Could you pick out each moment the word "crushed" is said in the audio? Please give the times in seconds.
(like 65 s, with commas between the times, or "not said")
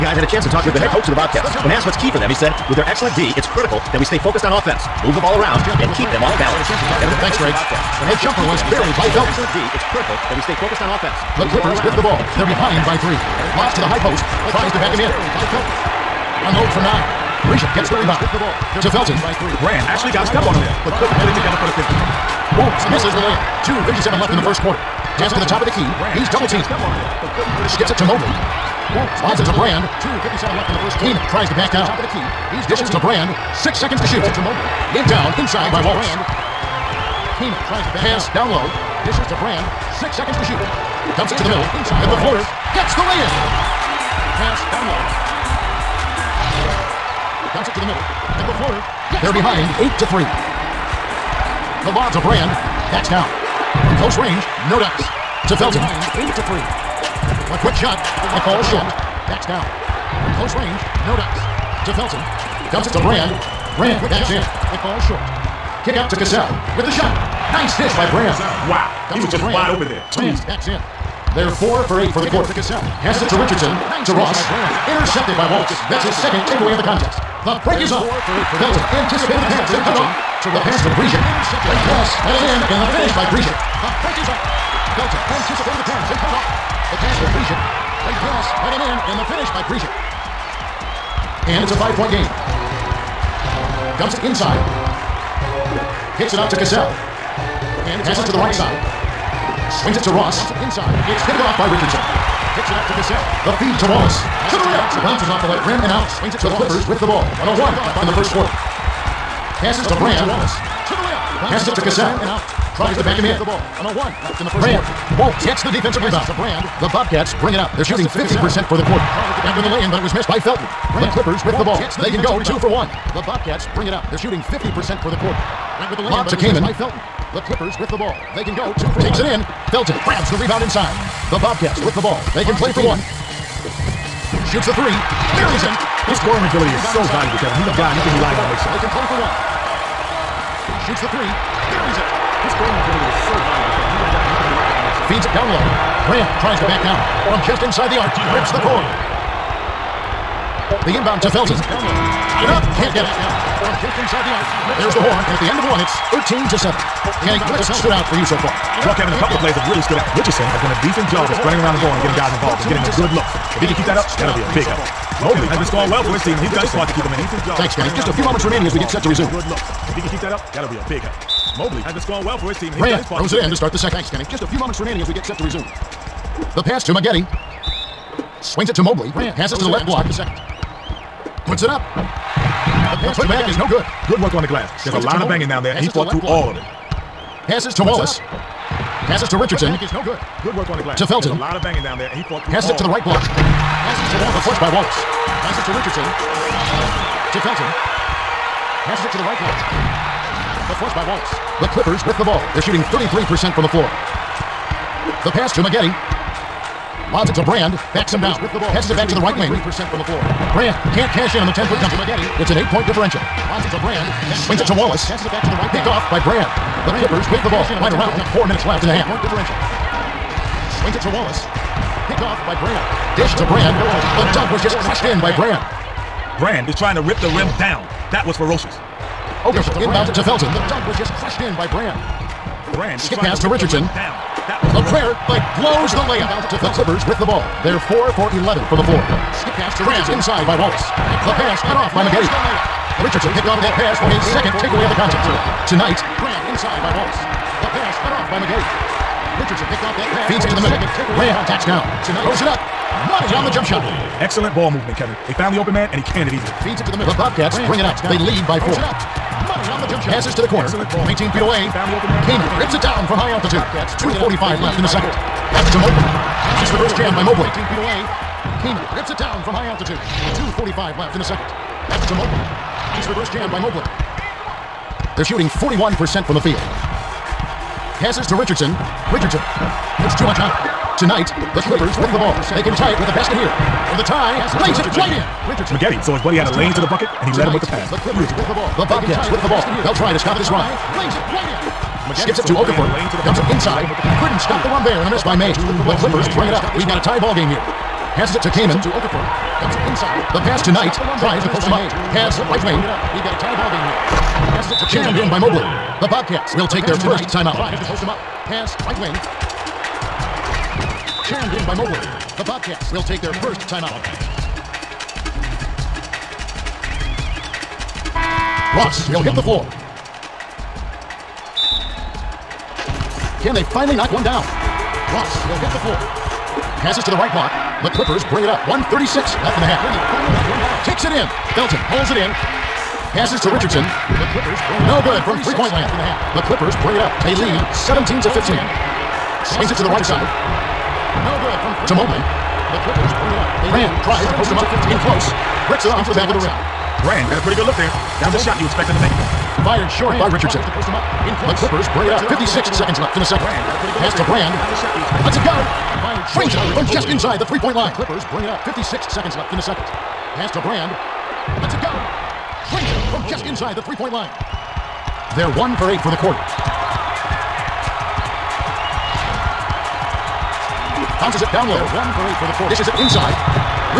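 224 s, 231 s.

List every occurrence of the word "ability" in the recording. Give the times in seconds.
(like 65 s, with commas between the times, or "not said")
136 s, 142 s.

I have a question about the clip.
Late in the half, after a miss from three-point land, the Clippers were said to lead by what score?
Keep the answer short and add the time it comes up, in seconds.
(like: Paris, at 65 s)
17 to 15, at 337 s.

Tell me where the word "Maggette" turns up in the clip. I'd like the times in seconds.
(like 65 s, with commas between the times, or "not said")
176 s, 205 s, 242 s, 248 s, 285 s.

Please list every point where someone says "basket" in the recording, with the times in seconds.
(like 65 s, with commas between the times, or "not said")
283 s.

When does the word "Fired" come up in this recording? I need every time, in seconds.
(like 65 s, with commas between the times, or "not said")
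349 s.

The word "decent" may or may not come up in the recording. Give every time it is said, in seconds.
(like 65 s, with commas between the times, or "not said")
160 s.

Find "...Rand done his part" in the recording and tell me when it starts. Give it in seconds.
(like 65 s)
172 s.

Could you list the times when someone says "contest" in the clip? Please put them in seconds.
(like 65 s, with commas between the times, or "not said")
76 s, 244 s.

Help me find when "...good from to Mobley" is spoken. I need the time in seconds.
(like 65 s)
341 s.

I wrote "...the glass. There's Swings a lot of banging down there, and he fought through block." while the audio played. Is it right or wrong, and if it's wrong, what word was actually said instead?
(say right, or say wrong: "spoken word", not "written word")
right.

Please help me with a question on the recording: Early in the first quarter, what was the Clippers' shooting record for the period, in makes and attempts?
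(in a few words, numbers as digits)
4 for 8.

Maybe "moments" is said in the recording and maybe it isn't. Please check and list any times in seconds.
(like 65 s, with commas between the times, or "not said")
168 s, 174 s.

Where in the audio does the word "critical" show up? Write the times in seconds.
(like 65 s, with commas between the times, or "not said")
3 s, 9 s.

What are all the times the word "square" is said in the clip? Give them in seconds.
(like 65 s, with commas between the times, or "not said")
not said.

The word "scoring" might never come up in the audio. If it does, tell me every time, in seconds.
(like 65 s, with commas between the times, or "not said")
136 s, 142 s, 165 s, 172 s.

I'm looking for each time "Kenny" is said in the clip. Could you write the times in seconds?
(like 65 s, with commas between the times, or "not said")
157 s, 167 s, 174 s.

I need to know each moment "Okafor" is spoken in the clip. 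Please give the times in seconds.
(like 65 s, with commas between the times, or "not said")
292 s, 298 s.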